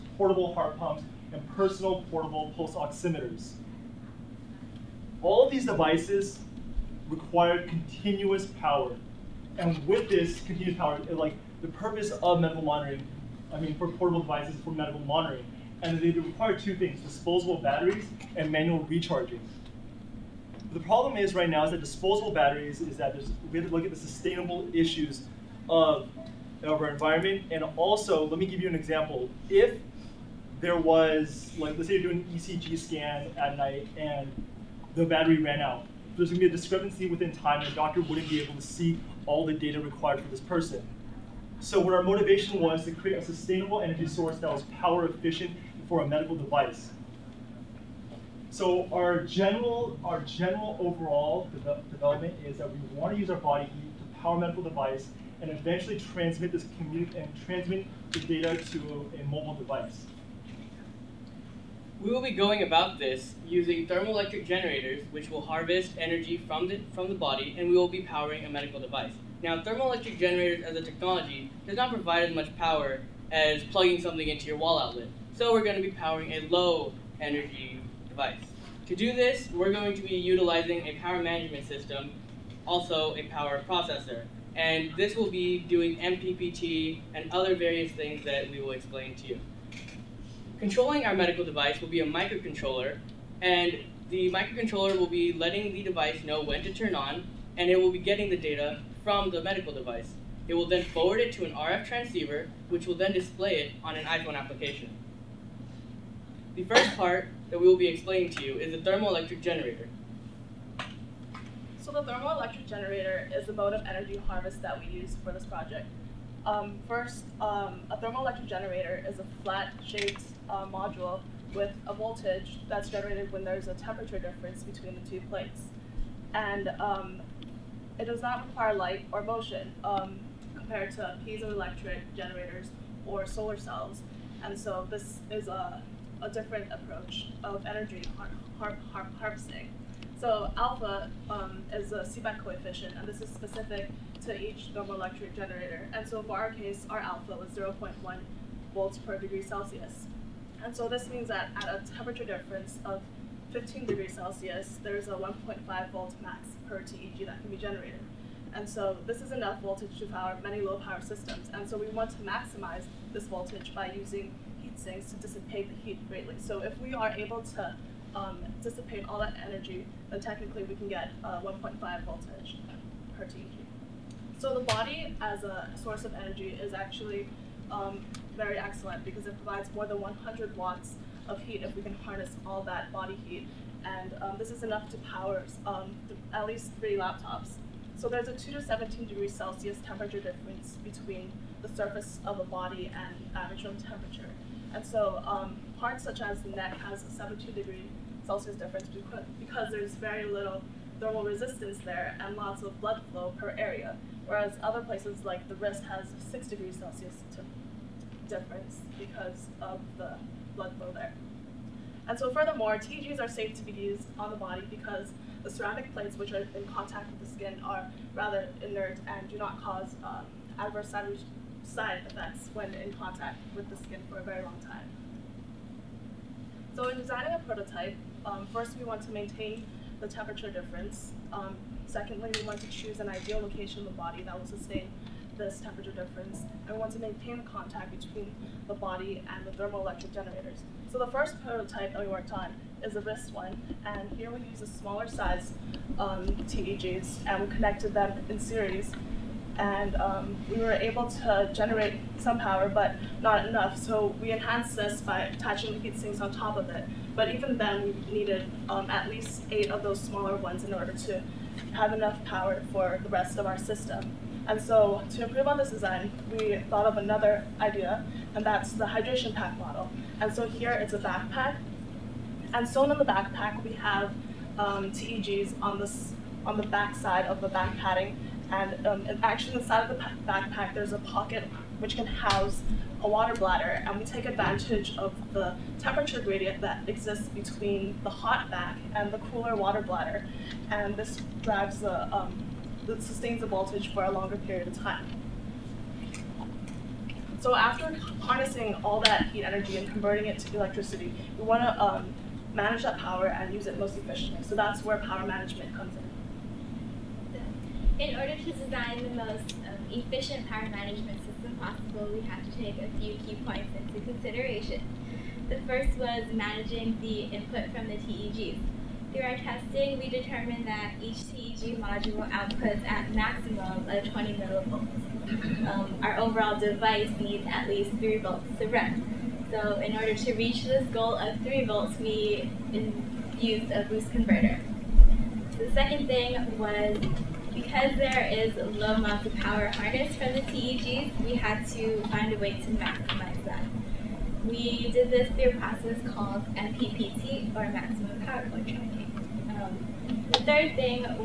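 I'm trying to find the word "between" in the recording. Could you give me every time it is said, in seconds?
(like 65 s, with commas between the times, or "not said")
124 s, 190 s, 237 s, 287 s.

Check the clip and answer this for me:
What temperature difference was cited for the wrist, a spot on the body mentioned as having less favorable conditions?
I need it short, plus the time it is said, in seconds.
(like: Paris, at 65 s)
6 degrees Celsius, at 206 s.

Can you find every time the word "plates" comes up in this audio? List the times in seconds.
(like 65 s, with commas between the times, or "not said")
125 s, 215 s.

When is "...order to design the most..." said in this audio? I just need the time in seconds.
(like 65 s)
308 s.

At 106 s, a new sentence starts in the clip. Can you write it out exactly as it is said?
The first part that we will be explaining to you is the thermoelectric generator.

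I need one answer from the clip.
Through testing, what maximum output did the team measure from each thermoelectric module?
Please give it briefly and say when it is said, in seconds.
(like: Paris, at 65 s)
20 millivolts, at 324 s.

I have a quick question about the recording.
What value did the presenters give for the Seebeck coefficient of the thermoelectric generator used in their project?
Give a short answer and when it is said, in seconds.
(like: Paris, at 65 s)
0.1 volts per degree Celsius, at 147 s.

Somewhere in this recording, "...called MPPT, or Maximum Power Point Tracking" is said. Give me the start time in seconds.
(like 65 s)
346 s.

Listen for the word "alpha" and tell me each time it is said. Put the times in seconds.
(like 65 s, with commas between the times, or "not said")
140 s, 146 s.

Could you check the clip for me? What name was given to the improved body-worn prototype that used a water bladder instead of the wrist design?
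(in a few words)
hydration pack model.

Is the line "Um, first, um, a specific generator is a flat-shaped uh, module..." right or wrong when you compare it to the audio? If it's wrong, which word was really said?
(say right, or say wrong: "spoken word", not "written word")
wrong: "thermoelectric", not "specific".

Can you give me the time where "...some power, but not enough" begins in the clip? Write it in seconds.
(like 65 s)
252 s.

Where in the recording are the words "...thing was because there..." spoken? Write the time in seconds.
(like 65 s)
336 s.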